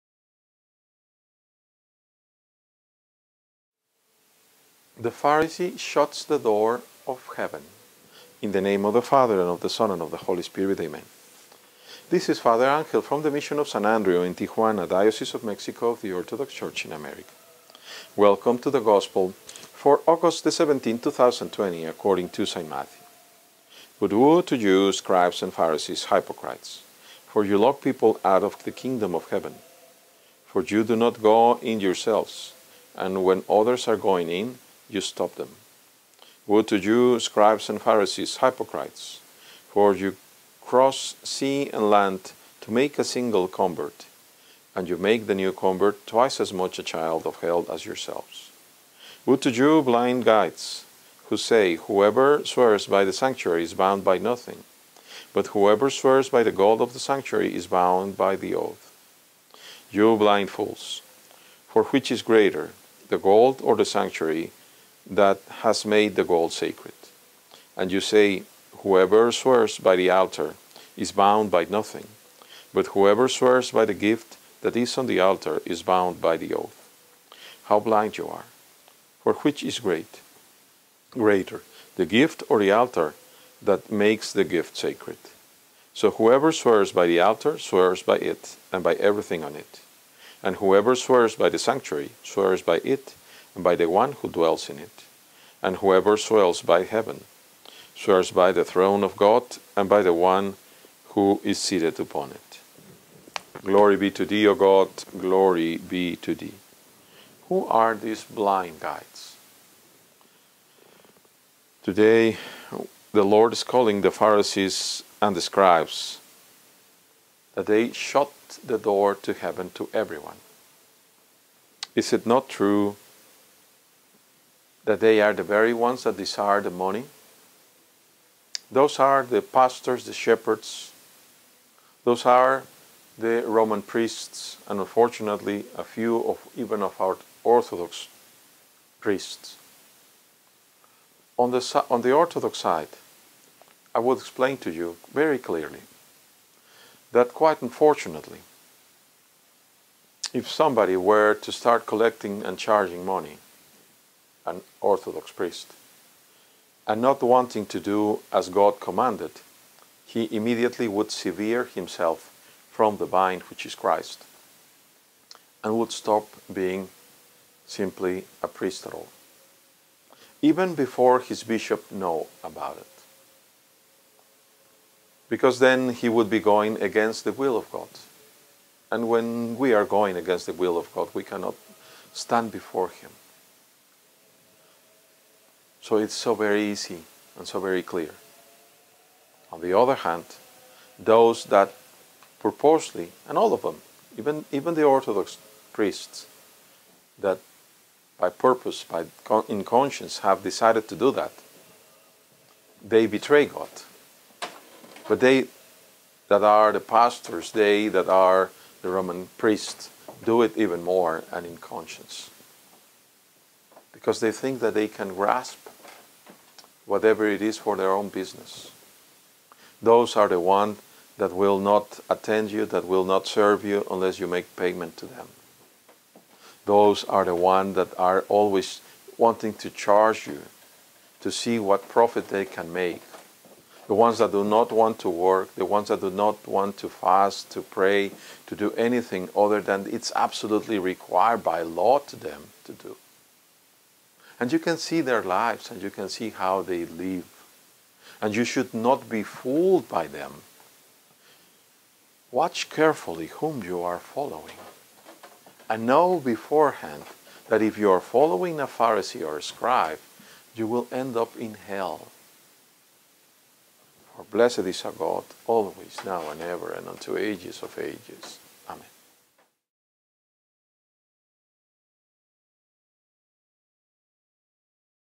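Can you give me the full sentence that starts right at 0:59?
You blind fools, for which is greater, the gold or the sanctuary that has made the gold sacred.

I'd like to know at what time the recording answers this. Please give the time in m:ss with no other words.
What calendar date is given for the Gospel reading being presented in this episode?
0:20.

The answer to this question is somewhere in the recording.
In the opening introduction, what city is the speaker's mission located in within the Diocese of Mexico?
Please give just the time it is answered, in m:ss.
0:14.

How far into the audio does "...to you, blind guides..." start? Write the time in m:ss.
0:49.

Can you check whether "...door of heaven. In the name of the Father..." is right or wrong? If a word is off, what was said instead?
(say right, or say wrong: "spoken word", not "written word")
right.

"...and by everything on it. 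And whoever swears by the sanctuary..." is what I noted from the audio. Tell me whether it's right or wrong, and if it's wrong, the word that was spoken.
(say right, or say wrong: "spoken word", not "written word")
right.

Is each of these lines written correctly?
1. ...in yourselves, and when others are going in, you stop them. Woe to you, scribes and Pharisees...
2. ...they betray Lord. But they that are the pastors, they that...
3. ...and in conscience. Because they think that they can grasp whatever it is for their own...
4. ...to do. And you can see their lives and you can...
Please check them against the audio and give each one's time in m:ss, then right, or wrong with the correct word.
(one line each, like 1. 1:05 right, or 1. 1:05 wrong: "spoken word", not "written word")
1. 0:31 right
2. 3:22 wrong: "God", not "Lord"
3. 3:31 right
4. 4:02 right.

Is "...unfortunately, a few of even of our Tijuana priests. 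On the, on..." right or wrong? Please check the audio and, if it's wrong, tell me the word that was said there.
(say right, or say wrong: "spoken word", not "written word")
wrong: "Orthodox", not "Tijuana".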